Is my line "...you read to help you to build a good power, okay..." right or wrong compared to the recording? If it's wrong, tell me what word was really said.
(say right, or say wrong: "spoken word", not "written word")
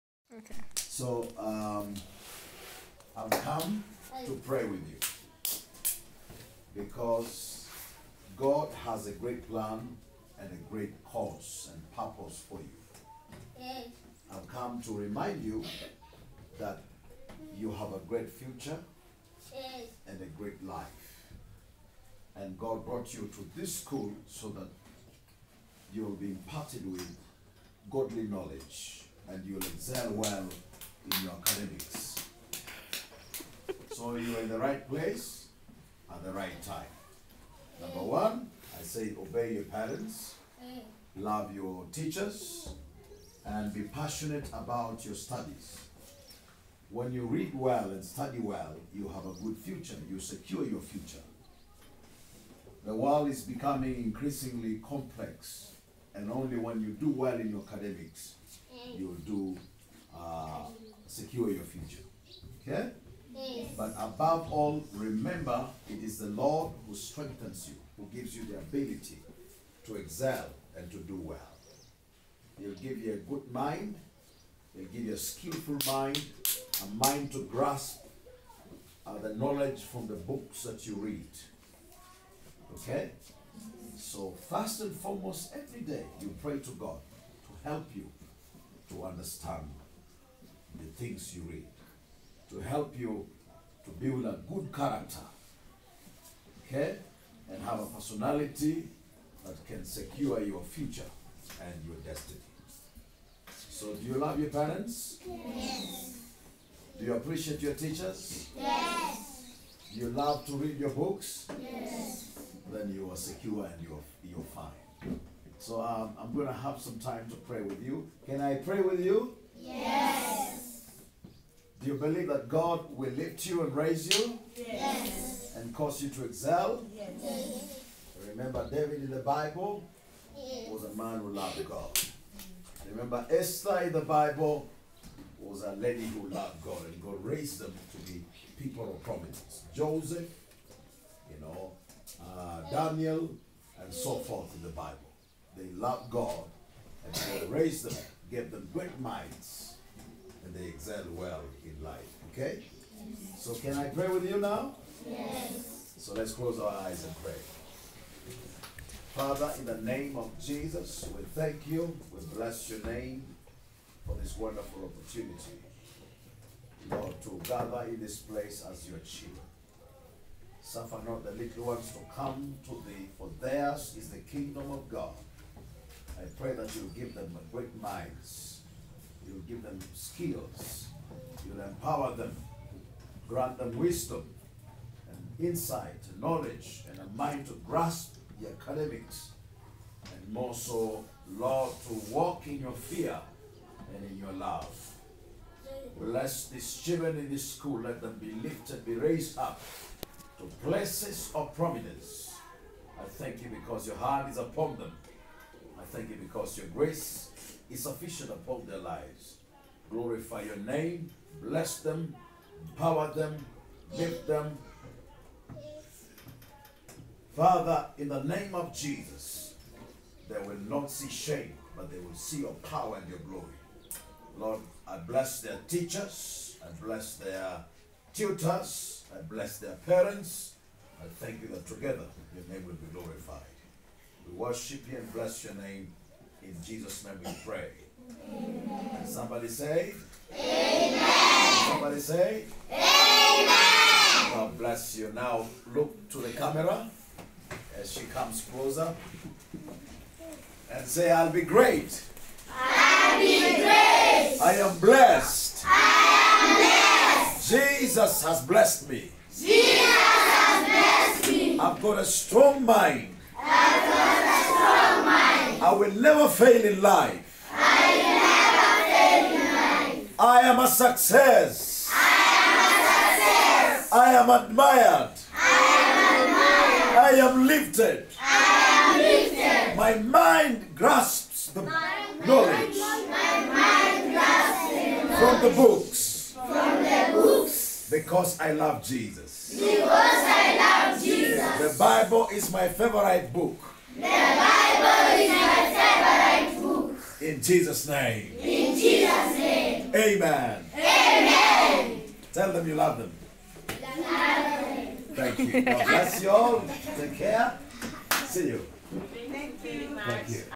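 wrong: "character", not "power".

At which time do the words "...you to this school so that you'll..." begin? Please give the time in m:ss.
0:23.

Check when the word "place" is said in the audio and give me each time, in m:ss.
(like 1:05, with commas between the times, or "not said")
0:34, 2:48, 3:20.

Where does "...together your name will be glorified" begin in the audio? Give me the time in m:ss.
3:51.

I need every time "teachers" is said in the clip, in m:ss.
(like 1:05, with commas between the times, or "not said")
0:41, 1:47, 3:45.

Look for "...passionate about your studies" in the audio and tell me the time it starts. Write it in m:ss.
0:43.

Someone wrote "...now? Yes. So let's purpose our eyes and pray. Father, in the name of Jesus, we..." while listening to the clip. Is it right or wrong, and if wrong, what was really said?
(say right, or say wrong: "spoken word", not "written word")
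wrong: "close", not "purpose".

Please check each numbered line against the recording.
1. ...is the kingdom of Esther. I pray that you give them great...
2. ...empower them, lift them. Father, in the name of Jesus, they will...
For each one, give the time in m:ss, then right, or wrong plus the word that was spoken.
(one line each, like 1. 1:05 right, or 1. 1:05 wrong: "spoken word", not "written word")
1. 2:53 wrong: "God", not "Esther"
2. 3:32 right.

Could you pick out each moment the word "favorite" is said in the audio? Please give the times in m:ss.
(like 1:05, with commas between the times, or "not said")
4:52.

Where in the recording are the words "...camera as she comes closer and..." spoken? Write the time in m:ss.
4:06.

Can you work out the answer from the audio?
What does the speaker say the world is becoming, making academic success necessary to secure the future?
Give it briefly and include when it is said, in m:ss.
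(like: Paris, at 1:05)
Increasingly complex, at 0:53.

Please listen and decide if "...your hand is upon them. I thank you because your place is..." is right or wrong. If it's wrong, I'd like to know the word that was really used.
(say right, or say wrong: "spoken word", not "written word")
wrong: "grace", not "place".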